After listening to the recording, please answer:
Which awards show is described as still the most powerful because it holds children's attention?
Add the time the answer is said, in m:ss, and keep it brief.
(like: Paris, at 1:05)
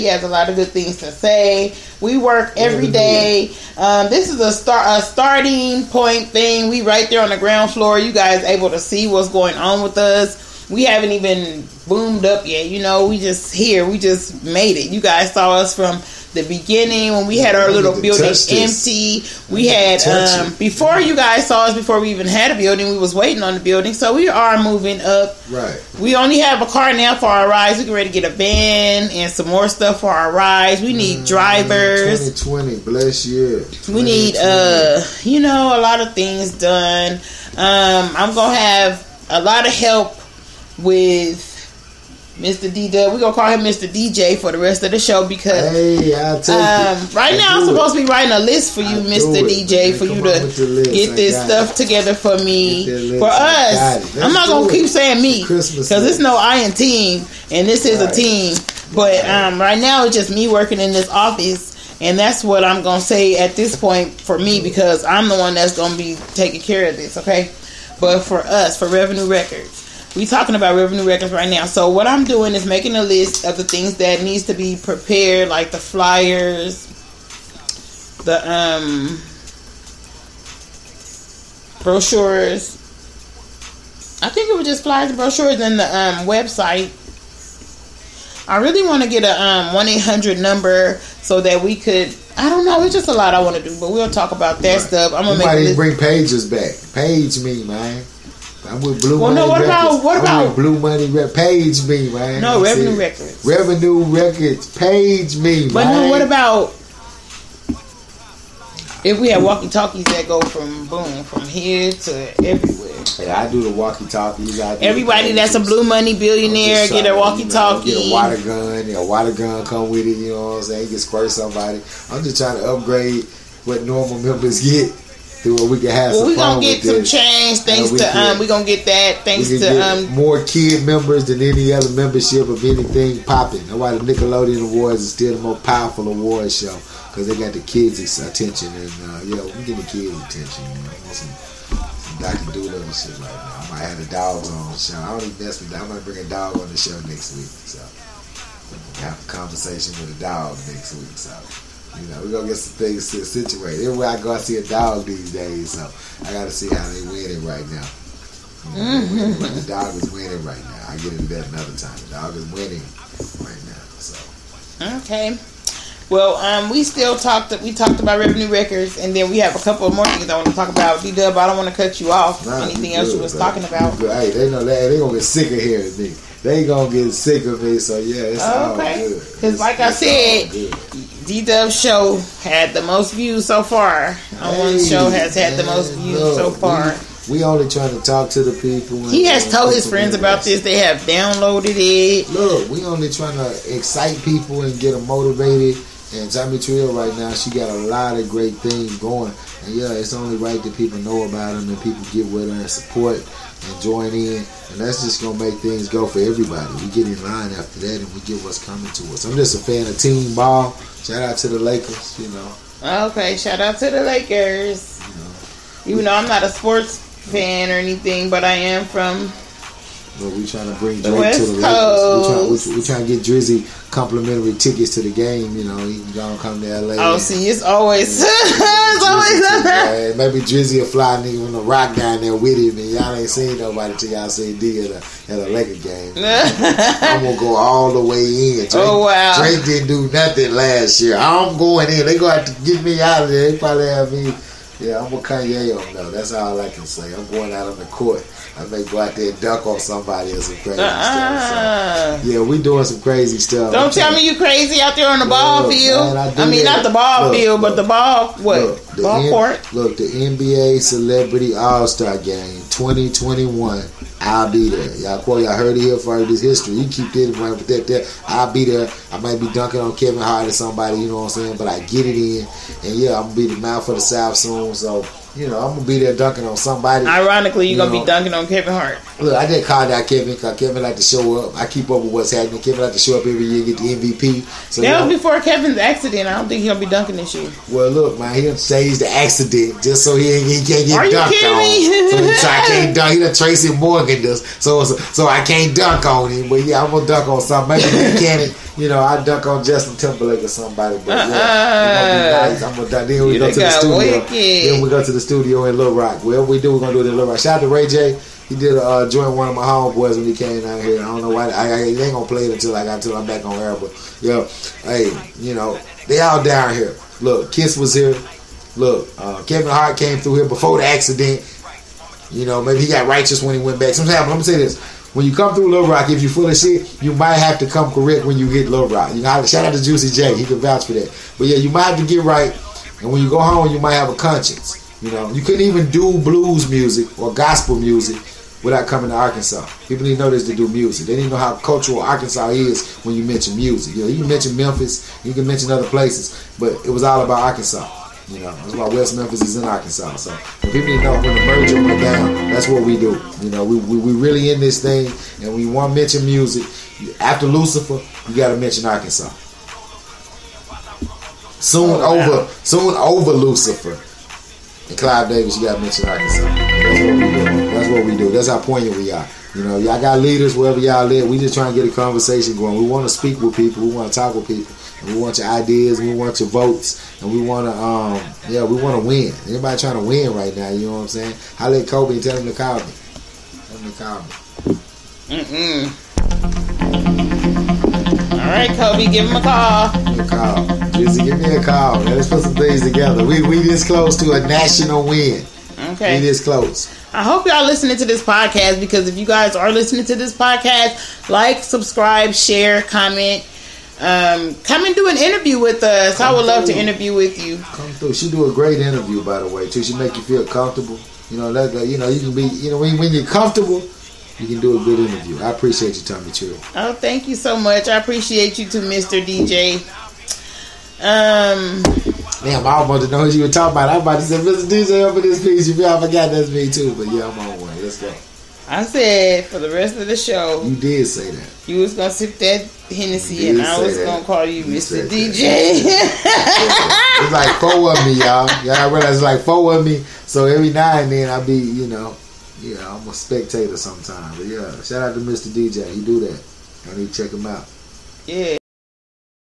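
Nickelodeon Awards, at 2:13.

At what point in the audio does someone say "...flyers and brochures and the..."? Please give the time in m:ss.
1:24.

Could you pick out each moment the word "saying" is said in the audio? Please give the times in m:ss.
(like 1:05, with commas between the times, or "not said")
0:54, 2:00, 4:31, 6:21.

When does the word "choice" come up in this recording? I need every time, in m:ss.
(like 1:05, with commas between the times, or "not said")
not said.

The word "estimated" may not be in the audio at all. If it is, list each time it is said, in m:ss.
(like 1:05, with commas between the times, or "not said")
not said.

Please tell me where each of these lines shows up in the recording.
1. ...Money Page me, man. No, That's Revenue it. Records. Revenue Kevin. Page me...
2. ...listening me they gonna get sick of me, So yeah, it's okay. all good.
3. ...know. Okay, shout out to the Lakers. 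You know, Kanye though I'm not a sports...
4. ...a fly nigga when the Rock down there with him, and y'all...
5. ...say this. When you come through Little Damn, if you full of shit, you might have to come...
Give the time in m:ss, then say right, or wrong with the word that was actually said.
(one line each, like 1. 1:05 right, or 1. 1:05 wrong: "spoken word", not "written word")
1. 1:40 wrong: "Records", not "Kevin"
2. 2:55 wrong: "hearing", not "listening"
3. 3:32 wrong: "Even", not "Kanye"
4. 3:50 right
5. 5:24 wrong: "Rock", not "Damn".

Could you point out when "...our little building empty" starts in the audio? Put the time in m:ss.
0:17.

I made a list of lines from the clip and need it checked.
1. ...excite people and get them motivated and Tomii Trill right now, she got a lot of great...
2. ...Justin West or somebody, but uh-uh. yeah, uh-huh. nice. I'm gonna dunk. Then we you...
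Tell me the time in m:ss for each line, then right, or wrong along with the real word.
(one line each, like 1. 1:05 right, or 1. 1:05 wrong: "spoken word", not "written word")
1. 3:13 right
2. 4:59 wrong: "Timberlake", not "West".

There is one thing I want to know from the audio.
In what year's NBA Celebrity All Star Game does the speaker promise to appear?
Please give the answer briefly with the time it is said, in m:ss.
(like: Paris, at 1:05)
2021, at 4:22.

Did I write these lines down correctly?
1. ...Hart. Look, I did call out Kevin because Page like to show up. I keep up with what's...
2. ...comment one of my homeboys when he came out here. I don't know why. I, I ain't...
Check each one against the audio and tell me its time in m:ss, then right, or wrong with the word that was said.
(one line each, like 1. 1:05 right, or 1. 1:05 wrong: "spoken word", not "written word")
1. 4:38 wrong: "Kevin", not "Page"
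2. 5:09 wrong: "joint", not "comment".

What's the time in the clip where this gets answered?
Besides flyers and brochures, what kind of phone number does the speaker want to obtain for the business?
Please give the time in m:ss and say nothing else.
1:29.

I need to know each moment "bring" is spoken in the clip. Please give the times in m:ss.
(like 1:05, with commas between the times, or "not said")
1:35, 2:26, 3:40.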